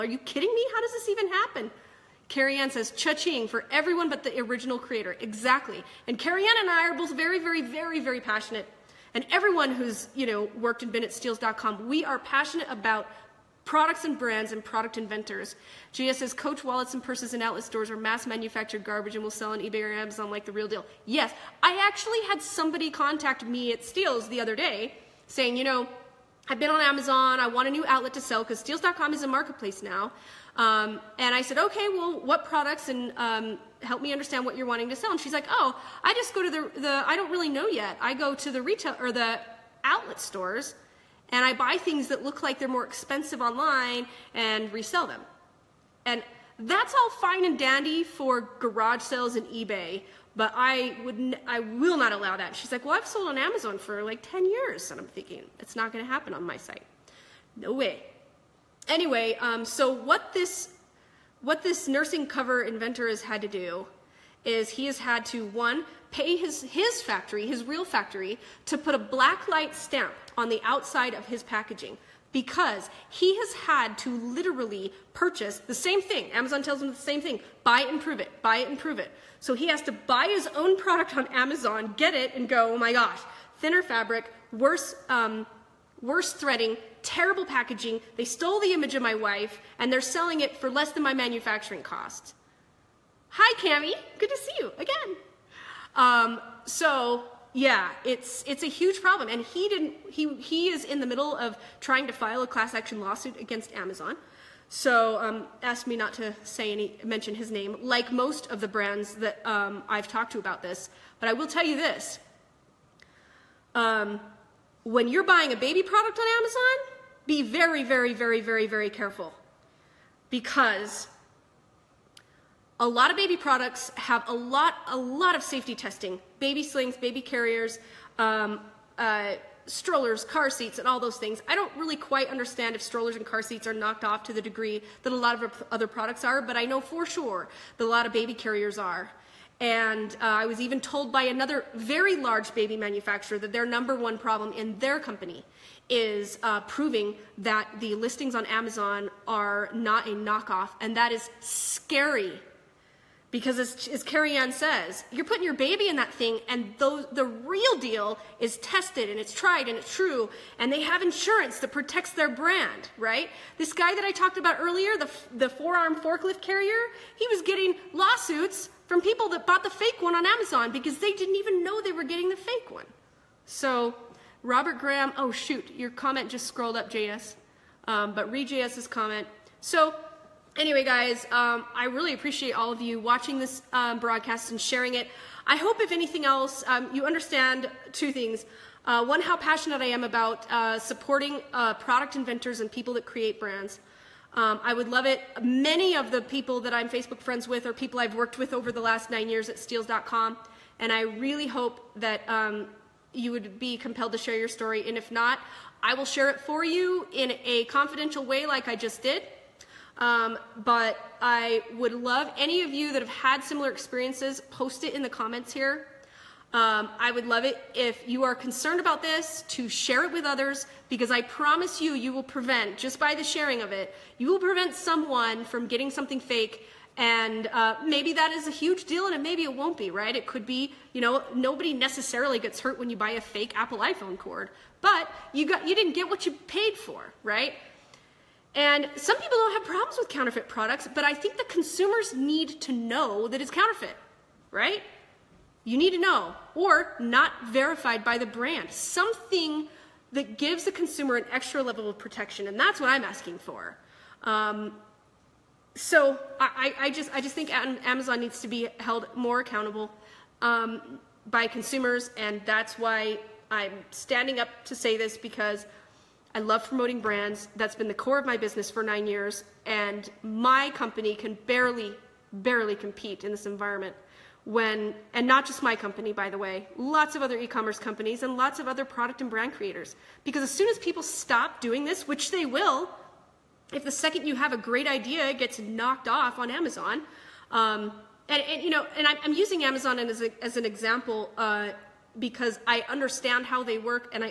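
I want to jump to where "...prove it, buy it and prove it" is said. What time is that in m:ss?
1:18.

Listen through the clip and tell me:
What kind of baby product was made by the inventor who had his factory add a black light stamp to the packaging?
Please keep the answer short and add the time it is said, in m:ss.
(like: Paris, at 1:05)
Nursing cover, at 1:01.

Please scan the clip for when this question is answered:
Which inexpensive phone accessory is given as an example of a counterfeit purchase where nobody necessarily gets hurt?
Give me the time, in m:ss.
3:53.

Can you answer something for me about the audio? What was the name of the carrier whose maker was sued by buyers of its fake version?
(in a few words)
Forearm forklift.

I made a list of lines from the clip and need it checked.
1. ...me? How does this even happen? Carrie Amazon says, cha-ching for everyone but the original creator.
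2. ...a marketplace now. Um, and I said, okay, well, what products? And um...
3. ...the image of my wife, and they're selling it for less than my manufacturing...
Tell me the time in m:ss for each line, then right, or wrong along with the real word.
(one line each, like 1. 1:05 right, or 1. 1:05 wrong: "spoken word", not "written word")
1. 0:00 wrong: "Ann", not "Amazon"
2. 0:29 right
3. 1:28 right.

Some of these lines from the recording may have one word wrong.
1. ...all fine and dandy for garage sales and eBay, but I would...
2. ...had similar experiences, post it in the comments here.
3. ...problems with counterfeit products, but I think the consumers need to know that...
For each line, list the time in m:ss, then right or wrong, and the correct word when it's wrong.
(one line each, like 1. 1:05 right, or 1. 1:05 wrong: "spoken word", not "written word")
1. 0:46 right
2. 3:33 right
3. 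3:59 right.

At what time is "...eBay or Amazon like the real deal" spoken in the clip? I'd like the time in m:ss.
0:19.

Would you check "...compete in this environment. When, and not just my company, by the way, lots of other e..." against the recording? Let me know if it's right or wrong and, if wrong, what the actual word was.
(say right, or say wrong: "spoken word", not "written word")
right.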